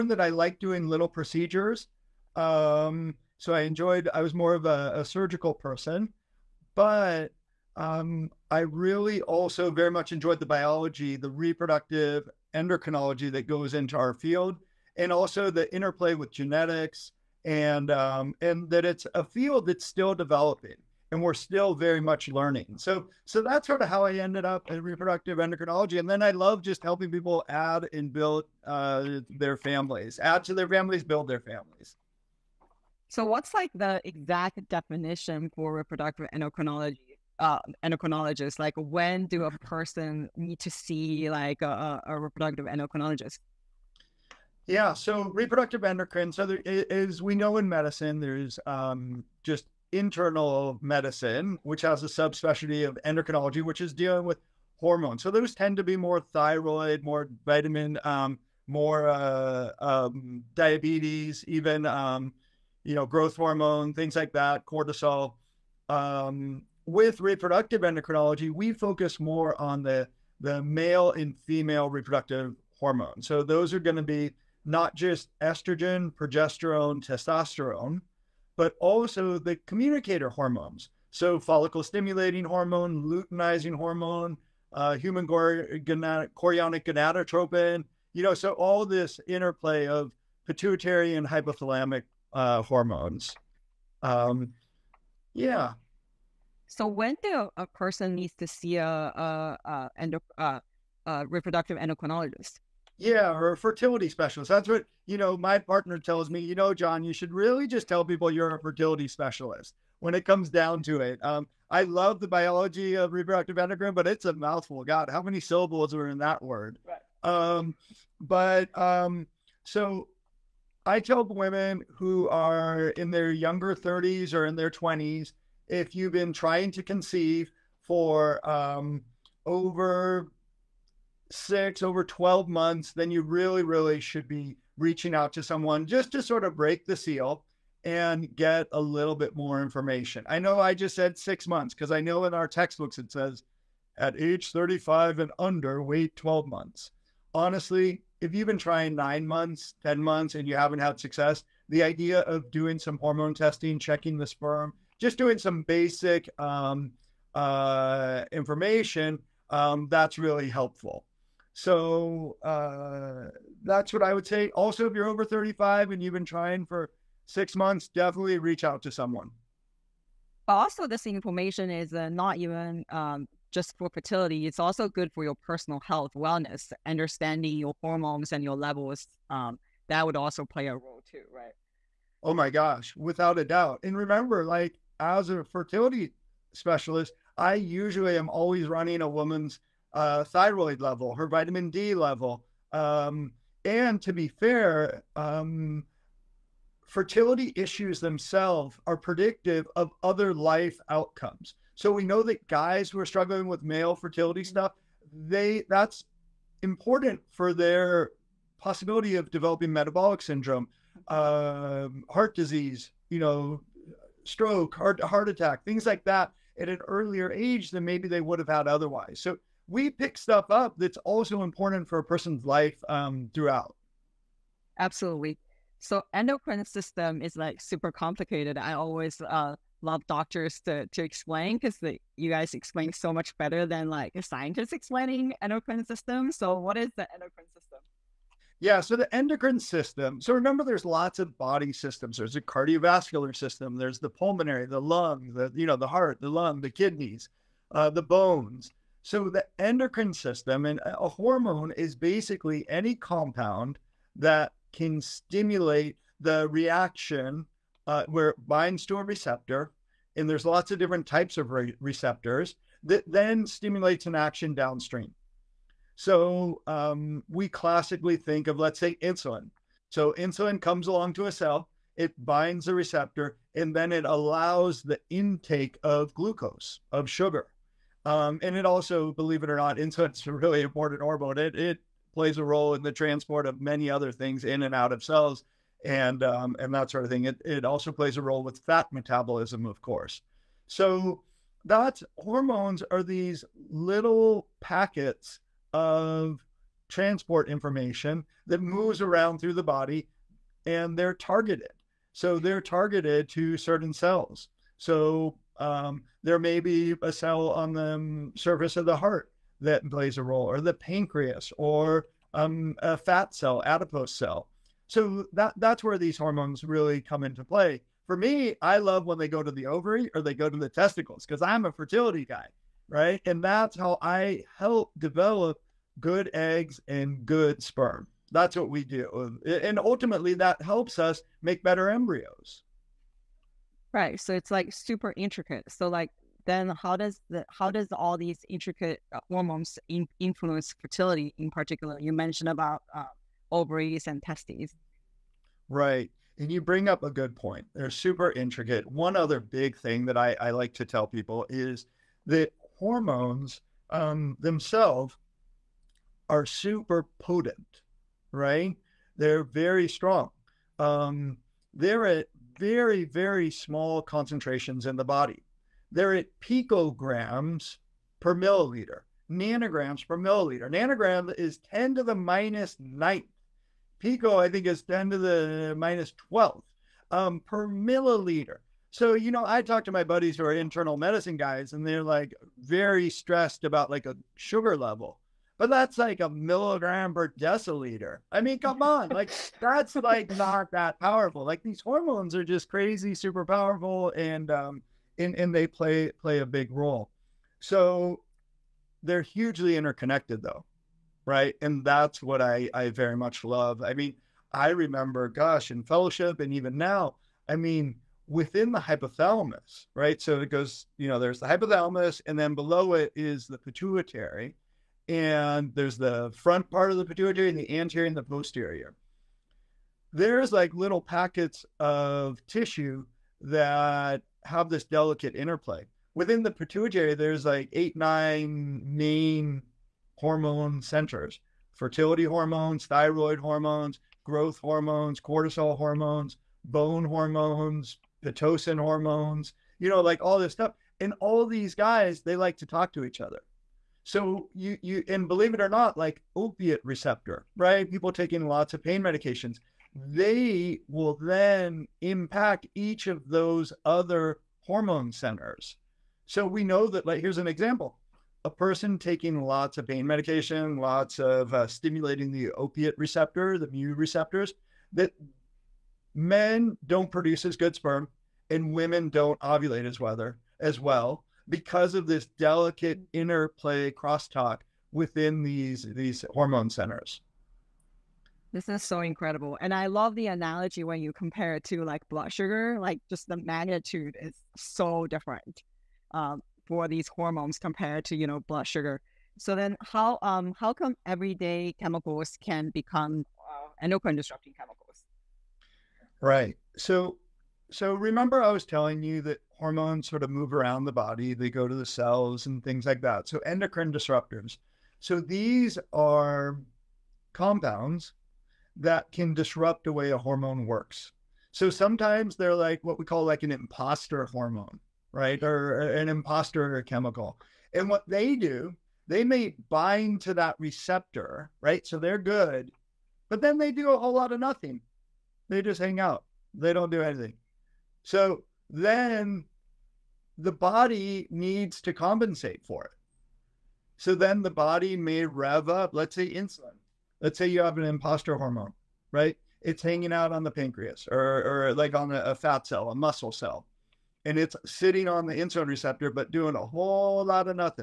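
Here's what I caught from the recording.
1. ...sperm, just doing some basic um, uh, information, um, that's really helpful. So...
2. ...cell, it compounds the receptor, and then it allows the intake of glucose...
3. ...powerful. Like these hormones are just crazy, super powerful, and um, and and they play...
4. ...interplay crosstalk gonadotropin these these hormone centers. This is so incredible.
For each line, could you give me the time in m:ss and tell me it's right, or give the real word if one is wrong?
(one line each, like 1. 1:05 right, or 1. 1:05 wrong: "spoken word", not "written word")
1. 2:34 right
2. 4:31 wrong: "binds", not "compounds"
3. 6:30 right
4. 7:53 wrong: "within", not "gonadotropin".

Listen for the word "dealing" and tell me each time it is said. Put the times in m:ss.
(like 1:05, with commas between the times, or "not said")
0:53.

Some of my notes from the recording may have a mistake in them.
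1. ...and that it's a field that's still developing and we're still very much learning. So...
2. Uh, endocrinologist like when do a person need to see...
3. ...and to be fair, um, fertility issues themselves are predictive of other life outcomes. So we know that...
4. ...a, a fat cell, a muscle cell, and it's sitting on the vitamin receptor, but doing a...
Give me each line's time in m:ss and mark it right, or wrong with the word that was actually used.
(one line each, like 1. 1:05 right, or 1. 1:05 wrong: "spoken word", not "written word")
1. 0:18 right
2. 0:37 right
3. 3:13 right
4. 9:02 wrong: "insulin", not "vitamin".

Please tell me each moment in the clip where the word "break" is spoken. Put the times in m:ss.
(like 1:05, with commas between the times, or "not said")
2:16.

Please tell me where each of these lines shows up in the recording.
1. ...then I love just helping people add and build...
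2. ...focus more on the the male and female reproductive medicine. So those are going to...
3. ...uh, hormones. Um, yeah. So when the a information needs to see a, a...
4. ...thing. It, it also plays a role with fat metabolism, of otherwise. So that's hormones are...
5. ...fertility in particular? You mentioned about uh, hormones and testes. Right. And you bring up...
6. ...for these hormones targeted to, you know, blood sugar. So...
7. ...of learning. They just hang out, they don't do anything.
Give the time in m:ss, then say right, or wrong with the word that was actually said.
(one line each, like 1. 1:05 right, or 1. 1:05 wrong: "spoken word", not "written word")
1. 0:26 right
2. 1:08 wrong: "hormone", not "medicine"
3. 1:32 wrong: "person", not "information"
4. 4:47 wrong: "course", not "otherwise"
5. 5:40 wrong: "ovaries", not "hormones"
6. 8:06 wrong: "compared", not "targeted"
7. 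8:44 wrong: "nothing", not "learning".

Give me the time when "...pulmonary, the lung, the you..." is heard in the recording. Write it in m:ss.
4:04.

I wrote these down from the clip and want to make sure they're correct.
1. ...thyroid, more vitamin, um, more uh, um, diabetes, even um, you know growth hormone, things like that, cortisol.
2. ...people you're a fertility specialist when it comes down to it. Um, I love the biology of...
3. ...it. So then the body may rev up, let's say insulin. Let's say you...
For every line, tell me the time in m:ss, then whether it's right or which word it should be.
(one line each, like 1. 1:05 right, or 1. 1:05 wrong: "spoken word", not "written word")
1. 0:56 right
2. 1:48 right
3. 8:52 right.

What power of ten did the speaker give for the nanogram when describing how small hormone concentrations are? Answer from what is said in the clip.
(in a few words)
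10 to the minus 9.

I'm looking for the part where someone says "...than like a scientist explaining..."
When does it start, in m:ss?
3:53.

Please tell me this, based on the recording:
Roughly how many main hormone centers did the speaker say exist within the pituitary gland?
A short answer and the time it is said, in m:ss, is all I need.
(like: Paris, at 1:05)
8 or 9, at 7:07.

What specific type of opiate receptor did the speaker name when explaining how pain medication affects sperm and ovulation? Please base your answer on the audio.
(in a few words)
mu receptors.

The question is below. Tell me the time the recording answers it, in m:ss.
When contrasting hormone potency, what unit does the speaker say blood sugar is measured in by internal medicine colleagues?
6:26.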